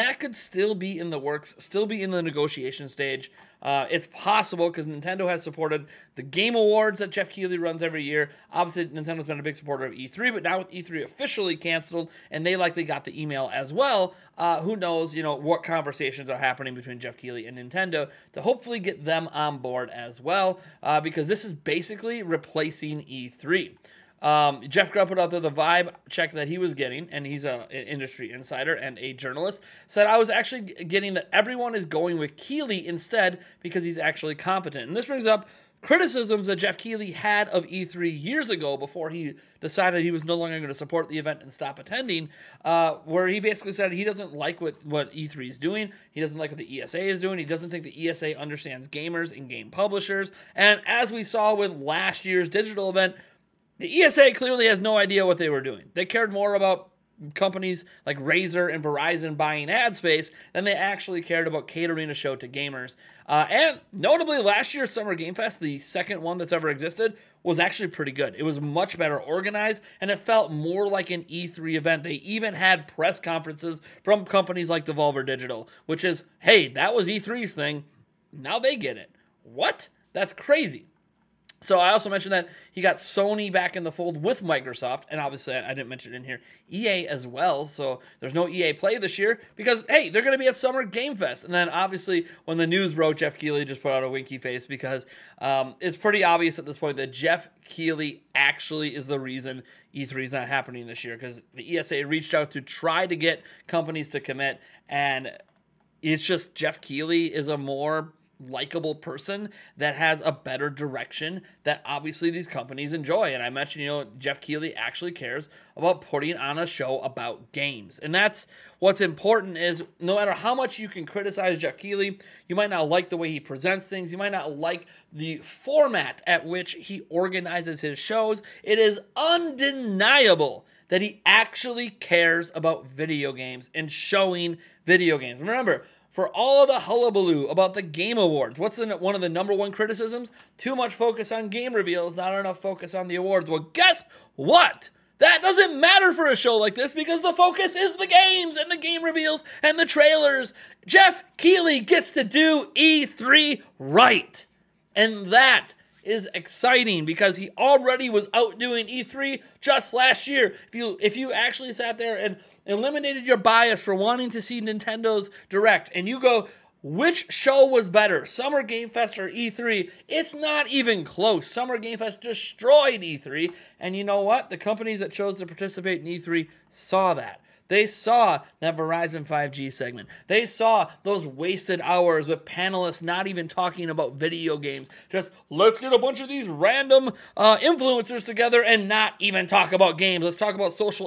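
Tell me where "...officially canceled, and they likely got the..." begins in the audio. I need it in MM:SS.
00:11.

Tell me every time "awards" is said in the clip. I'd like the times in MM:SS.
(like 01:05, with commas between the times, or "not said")
00:06, 02:18, 02:23.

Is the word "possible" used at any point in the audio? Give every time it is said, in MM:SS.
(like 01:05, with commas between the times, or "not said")
00:04.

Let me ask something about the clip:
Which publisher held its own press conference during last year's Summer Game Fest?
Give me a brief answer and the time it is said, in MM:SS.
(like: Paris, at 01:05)
Devolver Digital, at 01:14.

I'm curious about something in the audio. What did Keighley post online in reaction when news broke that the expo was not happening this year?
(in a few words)
A winky face.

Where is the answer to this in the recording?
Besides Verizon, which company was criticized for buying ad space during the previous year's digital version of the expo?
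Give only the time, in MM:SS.
00:58.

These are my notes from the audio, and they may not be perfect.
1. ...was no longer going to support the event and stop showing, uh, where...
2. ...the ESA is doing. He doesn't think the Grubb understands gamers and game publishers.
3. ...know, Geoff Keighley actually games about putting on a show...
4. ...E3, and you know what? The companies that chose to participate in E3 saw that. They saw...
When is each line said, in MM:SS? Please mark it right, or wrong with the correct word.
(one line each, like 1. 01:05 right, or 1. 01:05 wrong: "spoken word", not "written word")
1. 00:40 wrong: "attending", not "showing"
2. 00:46 wrong: "ESA", not "Grubb"
3. 01:53 wrong: "cares", not "games"
4. 02:53 right.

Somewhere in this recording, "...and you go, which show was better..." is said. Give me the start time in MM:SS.
02:45.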